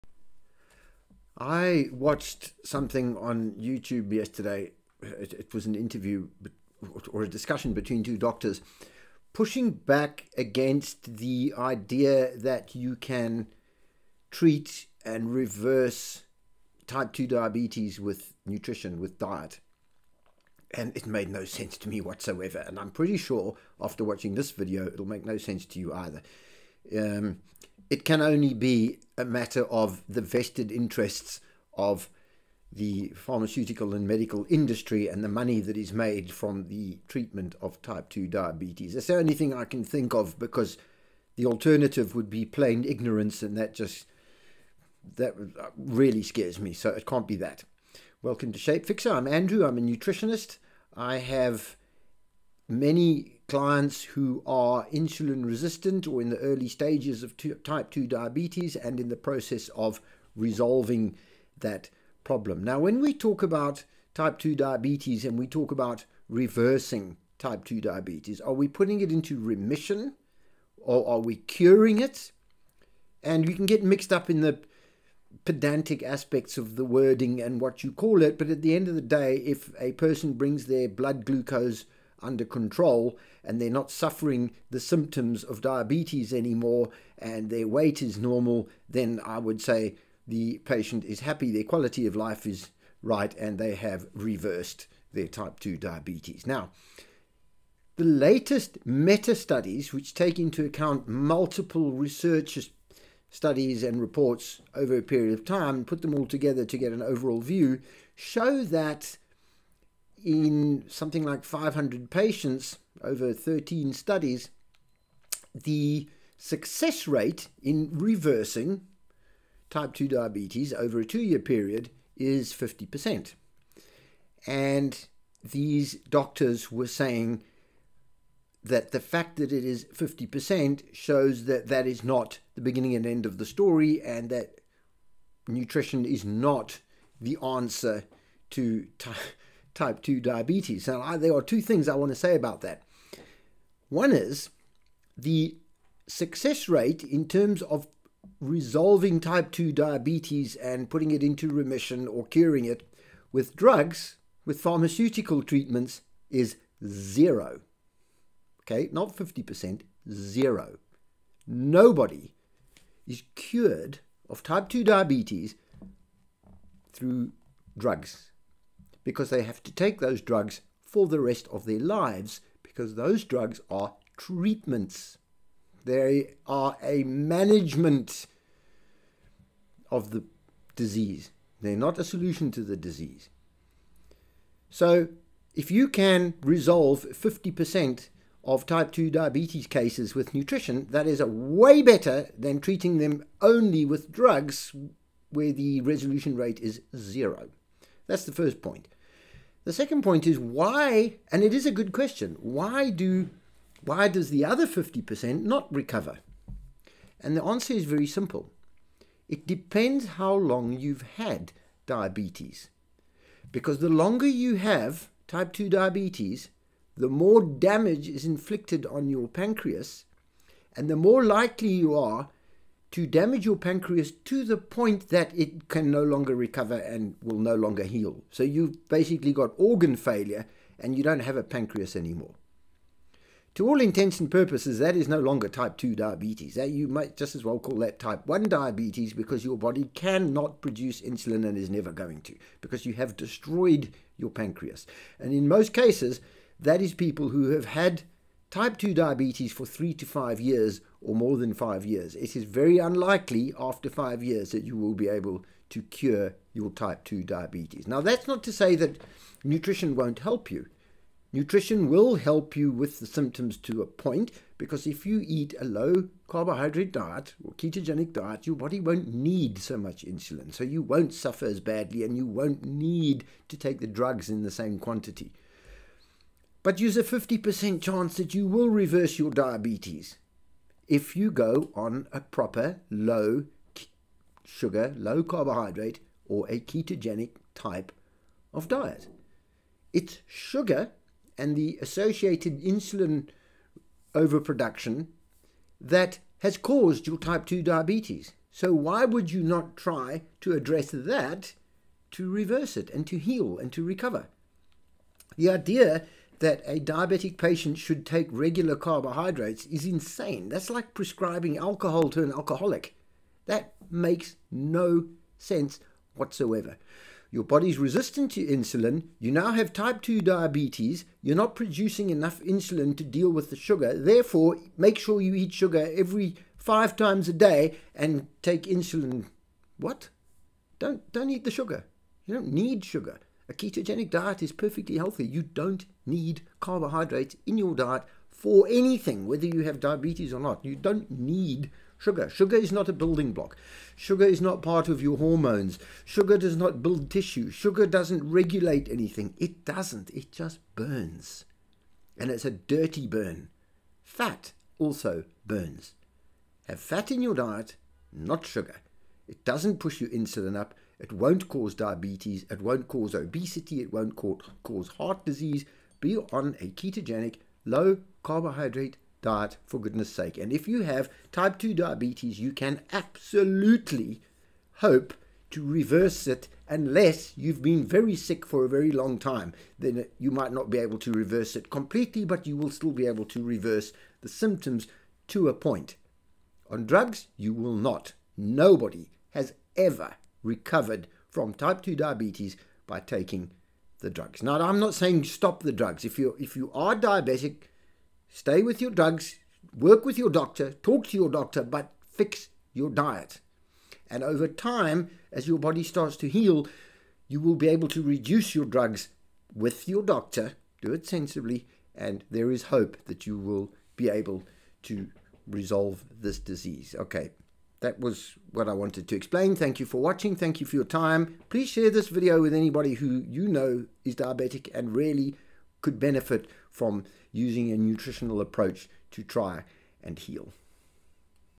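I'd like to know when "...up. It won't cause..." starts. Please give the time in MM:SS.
06:00.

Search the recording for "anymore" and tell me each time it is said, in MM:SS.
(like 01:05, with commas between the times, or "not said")
01:26, 03:51.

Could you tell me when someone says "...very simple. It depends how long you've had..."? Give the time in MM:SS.
03:27.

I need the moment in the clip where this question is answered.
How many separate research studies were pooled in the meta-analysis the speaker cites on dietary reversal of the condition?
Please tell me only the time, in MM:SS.
01:53.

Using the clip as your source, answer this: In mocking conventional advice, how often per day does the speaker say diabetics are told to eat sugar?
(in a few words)
5 times a day.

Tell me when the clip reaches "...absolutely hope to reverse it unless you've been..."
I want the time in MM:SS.
06:12.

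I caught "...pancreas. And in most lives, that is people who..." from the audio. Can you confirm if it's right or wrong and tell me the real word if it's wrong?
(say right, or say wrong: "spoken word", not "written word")
wrong: "cases", not "lives".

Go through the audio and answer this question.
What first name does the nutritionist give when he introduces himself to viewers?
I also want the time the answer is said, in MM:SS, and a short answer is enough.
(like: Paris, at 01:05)
Andrew, at 00:49.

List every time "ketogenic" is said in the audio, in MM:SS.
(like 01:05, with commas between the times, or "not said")
04:27, 04:46, 05:33, 06:06.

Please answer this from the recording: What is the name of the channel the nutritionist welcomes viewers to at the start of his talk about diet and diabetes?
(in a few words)
SHAPEFIXER.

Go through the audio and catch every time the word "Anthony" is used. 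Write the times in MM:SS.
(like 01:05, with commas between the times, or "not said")
not said.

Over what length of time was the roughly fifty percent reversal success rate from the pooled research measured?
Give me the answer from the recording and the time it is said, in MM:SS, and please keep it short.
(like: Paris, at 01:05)
2 years, at 02:01.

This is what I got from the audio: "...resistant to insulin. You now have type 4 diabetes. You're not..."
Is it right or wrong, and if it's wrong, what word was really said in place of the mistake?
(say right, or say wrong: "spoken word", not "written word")
wrong: "2", not "4".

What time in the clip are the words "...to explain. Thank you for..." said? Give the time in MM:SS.
06:59.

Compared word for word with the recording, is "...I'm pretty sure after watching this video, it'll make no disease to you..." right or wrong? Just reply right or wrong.
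wrong.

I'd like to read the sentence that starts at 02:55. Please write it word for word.
They are a management of the disease.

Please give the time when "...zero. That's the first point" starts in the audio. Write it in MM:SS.
03:16.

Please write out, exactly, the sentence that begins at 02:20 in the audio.
Now I, there are two things I want to say about that.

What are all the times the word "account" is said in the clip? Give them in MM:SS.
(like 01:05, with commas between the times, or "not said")
01:40.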